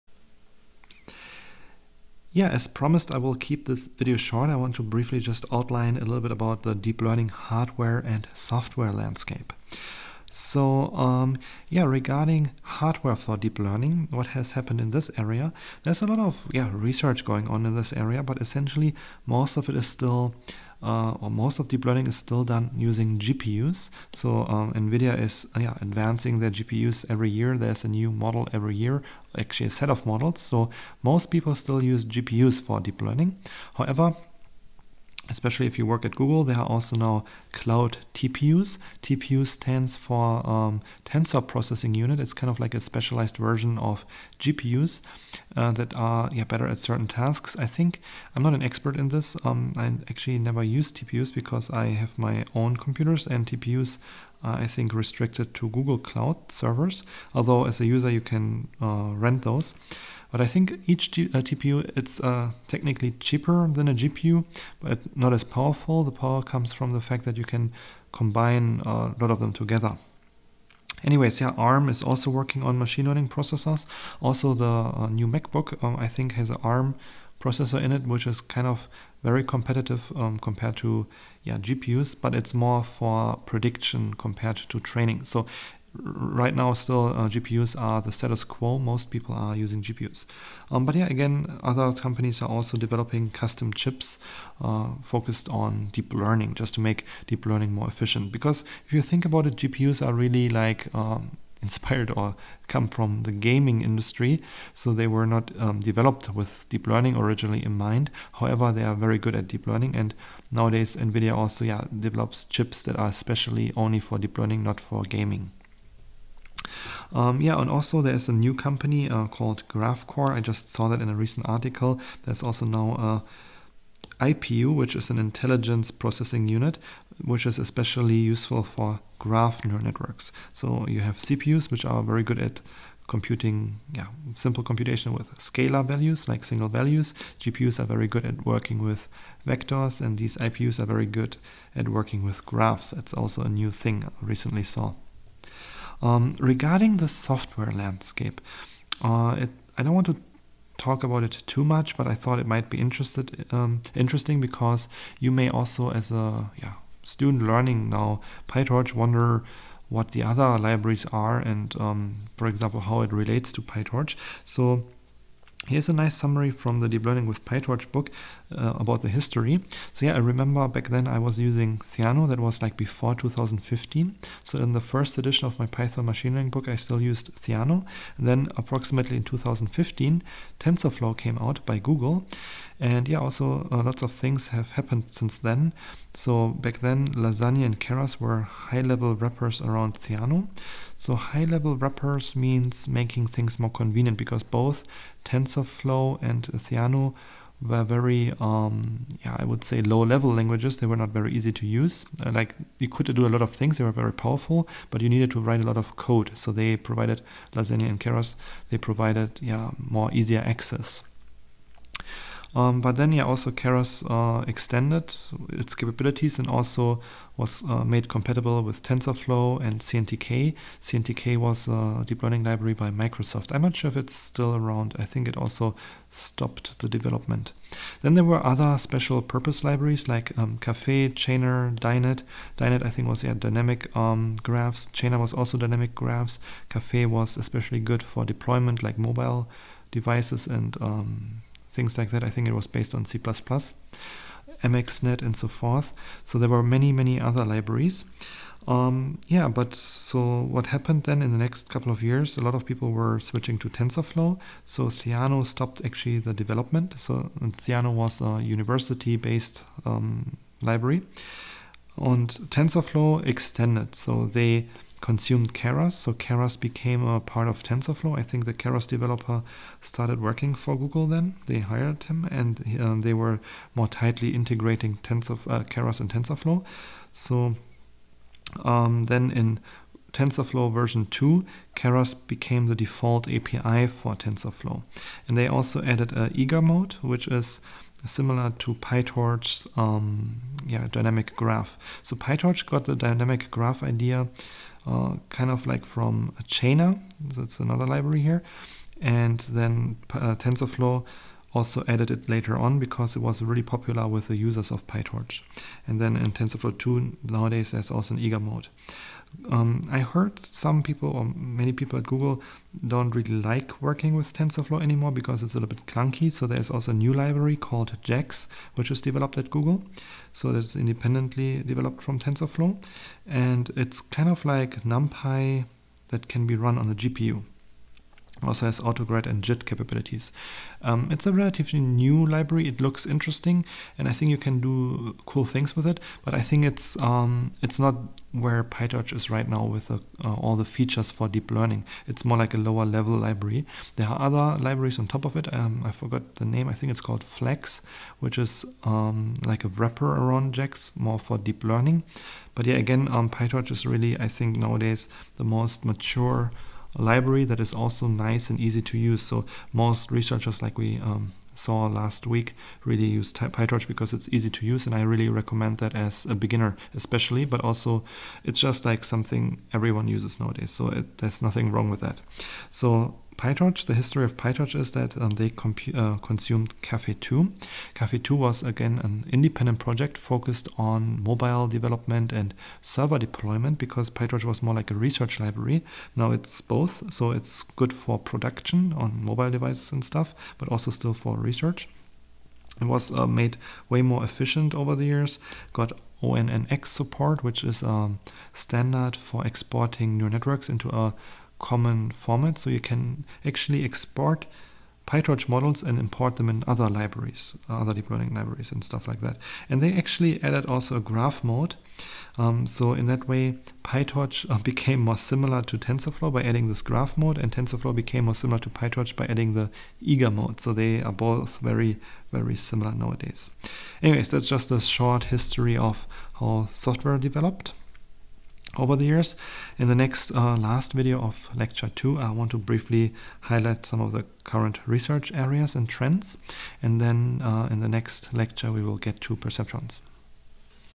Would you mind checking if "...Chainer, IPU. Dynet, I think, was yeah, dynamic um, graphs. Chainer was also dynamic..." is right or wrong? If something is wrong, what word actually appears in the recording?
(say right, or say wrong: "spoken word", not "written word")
wrong: "Dynet", not "IPU".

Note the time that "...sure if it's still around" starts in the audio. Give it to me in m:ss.
3:43.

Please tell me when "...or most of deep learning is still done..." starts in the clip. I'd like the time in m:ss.
0:21.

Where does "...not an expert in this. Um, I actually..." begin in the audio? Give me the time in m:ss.
0:48.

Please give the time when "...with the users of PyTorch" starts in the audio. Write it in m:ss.
5:04.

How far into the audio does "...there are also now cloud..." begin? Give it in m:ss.
0:36.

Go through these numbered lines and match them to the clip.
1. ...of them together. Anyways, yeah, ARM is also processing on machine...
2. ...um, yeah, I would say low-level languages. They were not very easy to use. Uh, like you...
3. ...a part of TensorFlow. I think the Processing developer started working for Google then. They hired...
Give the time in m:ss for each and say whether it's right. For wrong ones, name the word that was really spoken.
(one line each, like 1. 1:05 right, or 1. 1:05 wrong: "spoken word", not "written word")
1. 1:09 wrong: "working", not "processing"
2. 3:18 right
3. 4:27 wrong: "Keras", not "Processing".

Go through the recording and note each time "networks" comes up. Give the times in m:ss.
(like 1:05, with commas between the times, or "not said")
2:09, 6:40.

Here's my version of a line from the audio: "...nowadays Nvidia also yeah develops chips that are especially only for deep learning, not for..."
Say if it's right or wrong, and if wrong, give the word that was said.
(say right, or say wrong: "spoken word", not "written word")
right.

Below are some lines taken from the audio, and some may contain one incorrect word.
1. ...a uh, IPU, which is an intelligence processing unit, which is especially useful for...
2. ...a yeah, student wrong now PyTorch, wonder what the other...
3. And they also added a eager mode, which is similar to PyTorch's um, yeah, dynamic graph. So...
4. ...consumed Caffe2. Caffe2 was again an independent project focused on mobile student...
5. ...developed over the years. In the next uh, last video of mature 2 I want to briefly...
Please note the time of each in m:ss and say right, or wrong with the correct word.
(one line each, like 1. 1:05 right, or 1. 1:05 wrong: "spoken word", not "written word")
1. 2:04 right
2. 2:36 wrong: "learning", not "wrong"
3. 4:45 right
4. 6:16 wrong: "development", not "student"
5. 7:07 wrong: "lecture", not "mature".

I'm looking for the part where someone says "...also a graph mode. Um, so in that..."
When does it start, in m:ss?
6:50.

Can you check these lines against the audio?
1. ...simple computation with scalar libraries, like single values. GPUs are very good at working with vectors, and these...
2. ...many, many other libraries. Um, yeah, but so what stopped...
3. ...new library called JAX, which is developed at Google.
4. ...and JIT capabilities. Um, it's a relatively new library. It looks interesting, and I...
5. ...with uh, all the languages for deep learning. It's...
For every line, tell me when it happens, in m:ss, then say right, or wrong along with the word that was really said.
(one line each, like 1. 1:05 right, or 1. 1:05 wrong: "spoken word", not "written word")
1. 2:14 wrong: "values", not "libraries"
2. 4:06 wrong: "happened", not "stopped"
3. 5:16 right
4. 5:29 right
5. 5:39 wrong: "features", not "languages".